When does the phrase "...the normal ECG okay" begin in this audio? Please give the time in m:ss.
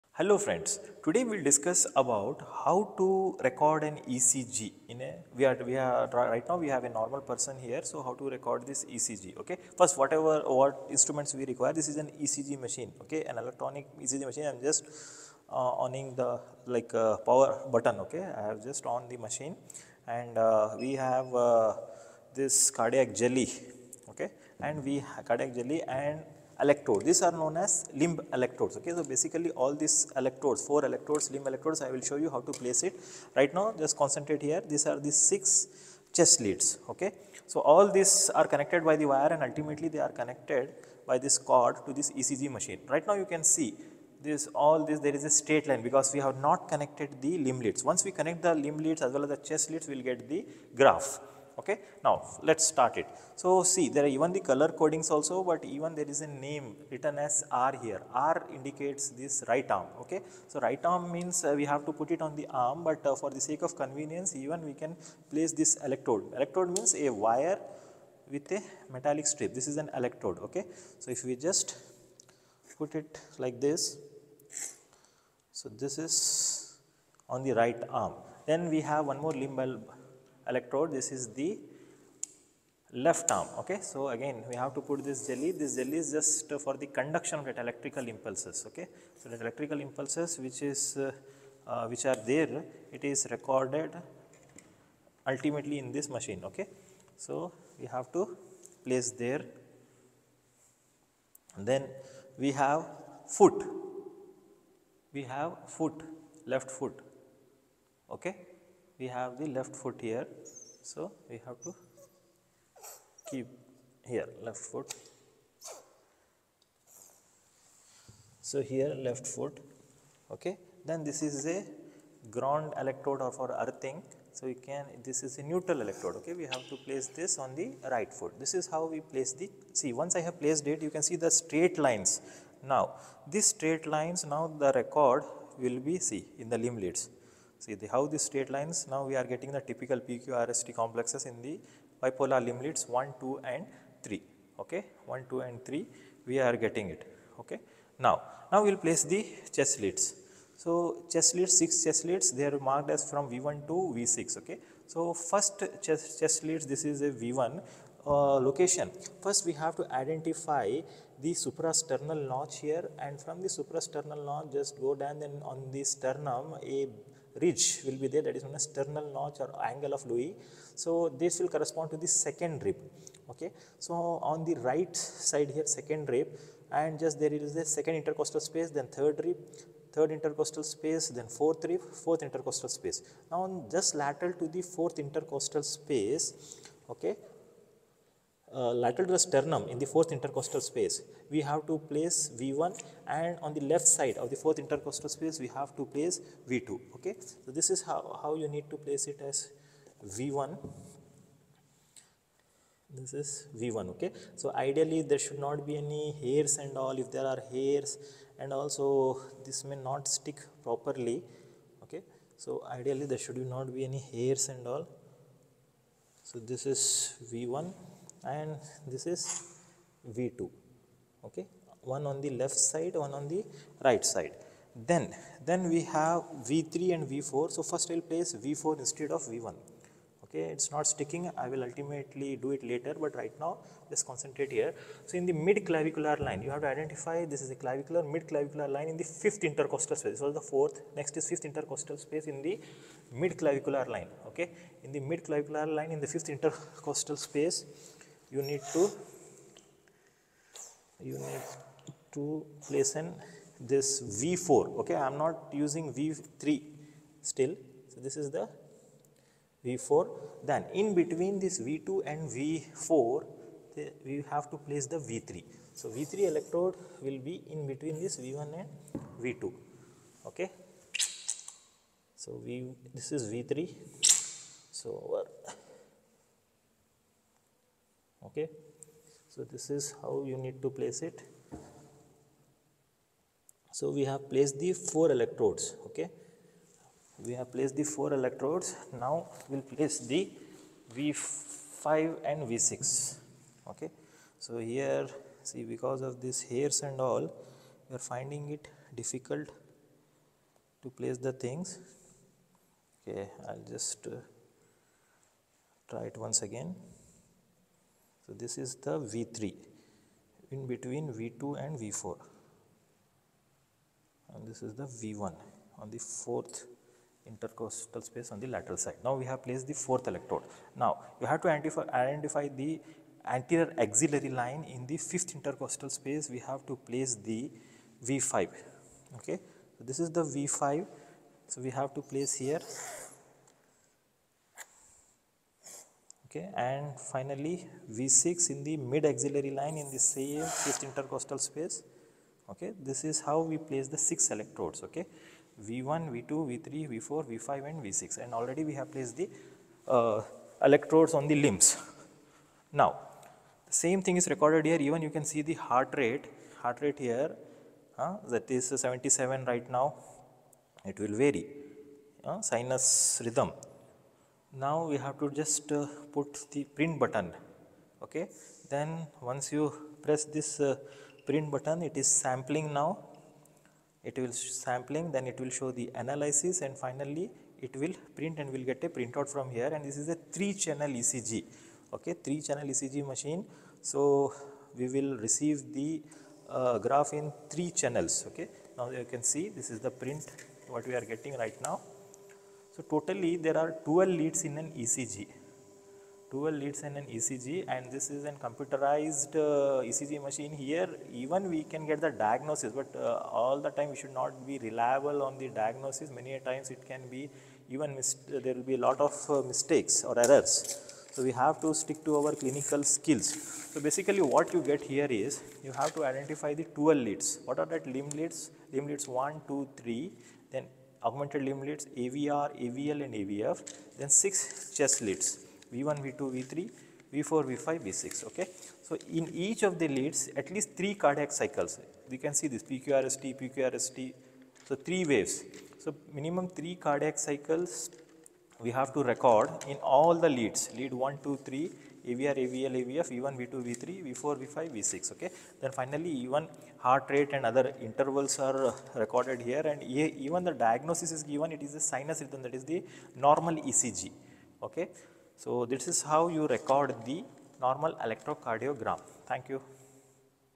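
7:32.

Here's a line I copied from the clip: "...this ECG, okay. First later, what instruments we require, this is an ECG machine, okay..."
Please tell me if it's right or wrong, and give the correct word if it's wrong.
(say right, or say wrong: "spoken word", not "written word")
wrong: "whatever", not "later".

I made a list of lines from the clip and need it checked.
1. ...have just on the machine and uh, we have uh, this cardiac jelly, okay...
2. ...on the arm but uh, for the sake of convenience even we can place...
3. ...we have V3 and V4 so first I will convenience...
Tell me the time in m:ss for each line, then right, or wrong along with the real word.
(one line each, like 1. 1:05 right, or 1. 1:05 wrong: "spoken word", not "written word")
1. 0:18 right
2. 1:02 right
3. 3:45 wrong: "place", not "convenience".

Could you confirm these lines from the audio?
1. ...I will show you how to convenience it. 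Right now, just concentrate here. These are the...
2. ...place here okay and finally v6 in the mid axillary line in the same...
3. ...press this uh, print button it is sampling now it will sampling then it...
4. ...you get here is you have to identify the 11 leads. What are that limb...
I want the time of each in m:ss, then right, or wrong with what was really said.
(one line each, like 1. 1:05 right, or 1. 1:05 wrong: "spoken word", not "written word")
1. 0:31 wrong: "place", not "convenience"
2. 5:32 right
3. 6:10 right
4. 6:54 wrong: "12", not "11".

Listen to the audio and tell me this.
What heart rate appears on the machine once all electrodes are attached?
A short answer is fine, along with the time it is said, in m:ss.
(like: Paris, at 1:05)
77, at 5:58.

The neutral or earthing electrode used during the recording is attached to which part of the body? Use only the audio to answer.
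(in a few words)
right foot.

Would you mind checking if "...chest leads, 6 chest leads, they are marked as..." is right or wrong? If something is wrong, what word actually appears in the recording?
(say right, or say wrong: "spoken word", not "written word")
right.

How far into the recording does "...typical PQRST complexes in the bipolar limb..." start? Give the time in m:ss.
2:19.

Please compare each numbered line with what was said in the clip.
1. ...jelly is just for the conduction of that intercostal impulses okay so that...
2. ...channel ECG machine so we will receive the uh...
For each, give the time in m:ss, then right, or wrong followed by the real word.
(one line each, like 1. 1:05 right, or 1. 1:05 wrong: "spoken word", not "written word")
1. 1:25 wrong: "electrical", not "intercostal"
2. 6:22 right.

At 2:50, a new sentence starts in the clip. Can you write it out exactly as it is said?
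So, this will correspond to the second rib.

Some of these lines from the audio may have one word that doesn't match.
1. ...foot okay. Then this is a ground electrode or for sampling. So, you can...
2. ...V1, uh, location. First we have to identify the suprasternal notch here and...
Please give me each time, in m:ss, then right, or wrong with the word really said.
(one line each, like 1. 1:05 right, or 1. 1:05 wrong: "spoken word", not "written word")
1. 1:59 wrong: "earthing", not "sampling"
2. 2:37 right.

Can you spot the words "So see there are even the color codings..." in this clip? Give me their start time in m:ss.
0:53.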